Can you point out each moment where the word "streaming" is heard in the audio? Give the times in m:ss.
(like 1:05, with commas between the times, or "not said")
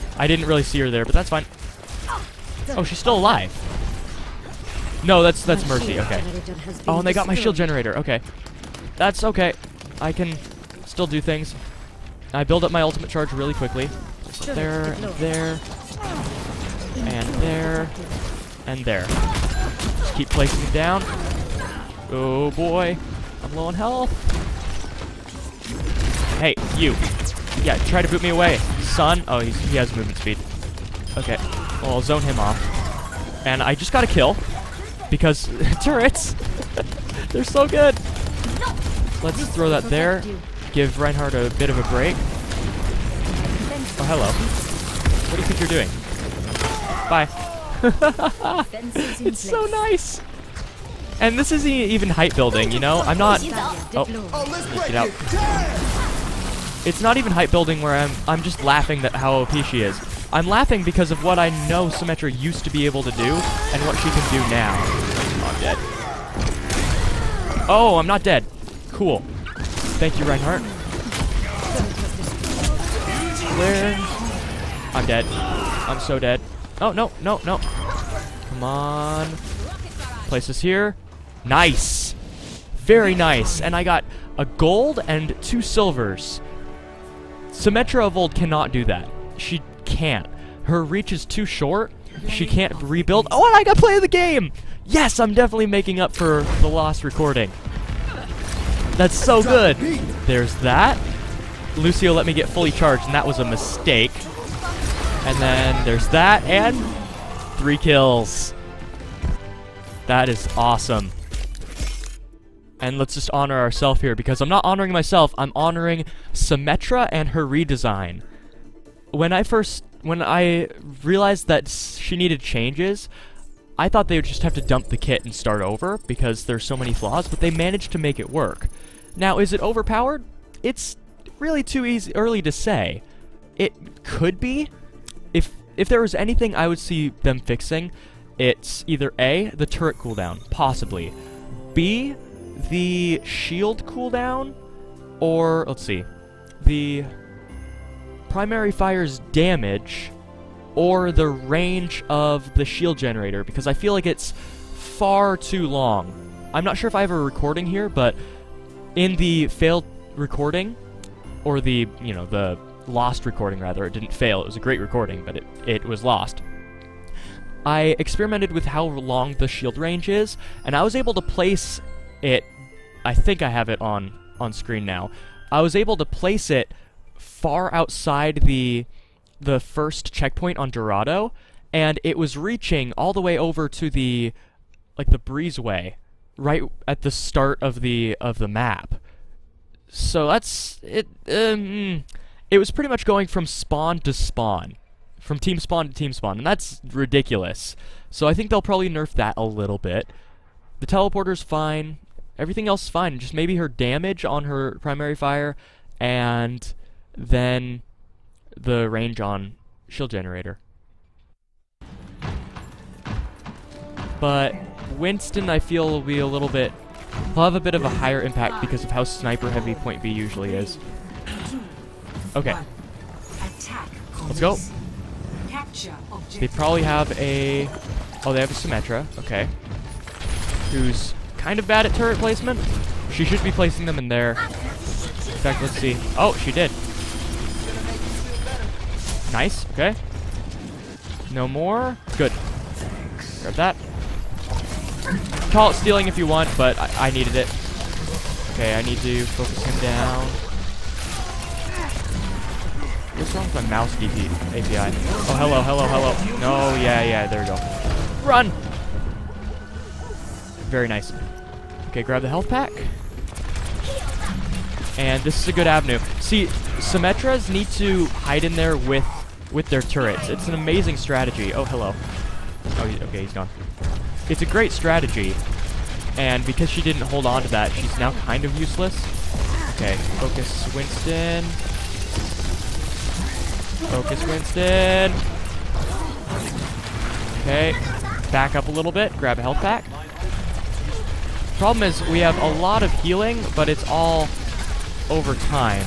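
not said.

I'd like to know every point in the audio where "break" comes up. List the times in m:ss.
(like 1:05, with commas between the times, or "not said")
0:41.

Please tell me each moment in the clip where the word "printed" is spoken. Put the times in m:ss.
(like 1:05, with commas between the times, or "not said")
not said.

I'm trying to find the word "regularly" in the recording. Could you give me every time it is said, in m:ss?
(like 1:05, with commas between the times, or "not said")
not said.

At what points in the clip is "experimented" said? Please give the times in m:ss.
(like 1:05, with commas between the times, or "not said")
2:47.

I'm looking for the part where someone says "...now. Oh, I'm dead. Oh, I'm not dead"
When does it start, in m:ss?
1:04.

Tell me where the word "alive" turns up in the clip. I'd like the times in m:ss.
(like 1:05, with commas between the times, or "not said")
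0:03.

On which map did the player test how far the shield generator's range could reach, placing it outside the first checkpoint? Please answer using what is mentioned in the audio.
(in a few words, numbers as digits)
Dorado.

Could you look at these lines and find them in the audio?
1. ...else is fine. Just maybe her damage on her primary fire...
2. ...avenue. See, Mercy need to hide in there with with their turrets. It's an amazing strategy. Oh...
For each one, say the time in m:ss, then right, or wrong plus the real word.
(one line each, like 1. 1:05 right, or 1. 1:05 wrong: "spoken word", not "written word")
1. 3:22 right
2. 4:25 wrong: "Symmetras", not "Mercy".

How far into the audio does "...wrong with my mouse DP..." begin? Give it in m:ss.
4:13.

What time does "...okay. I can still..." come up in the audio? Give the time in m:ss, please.
0:09.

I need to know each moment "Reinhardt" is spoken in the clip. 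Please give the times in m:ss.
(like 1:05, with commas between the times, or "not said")
0:41, 1:10.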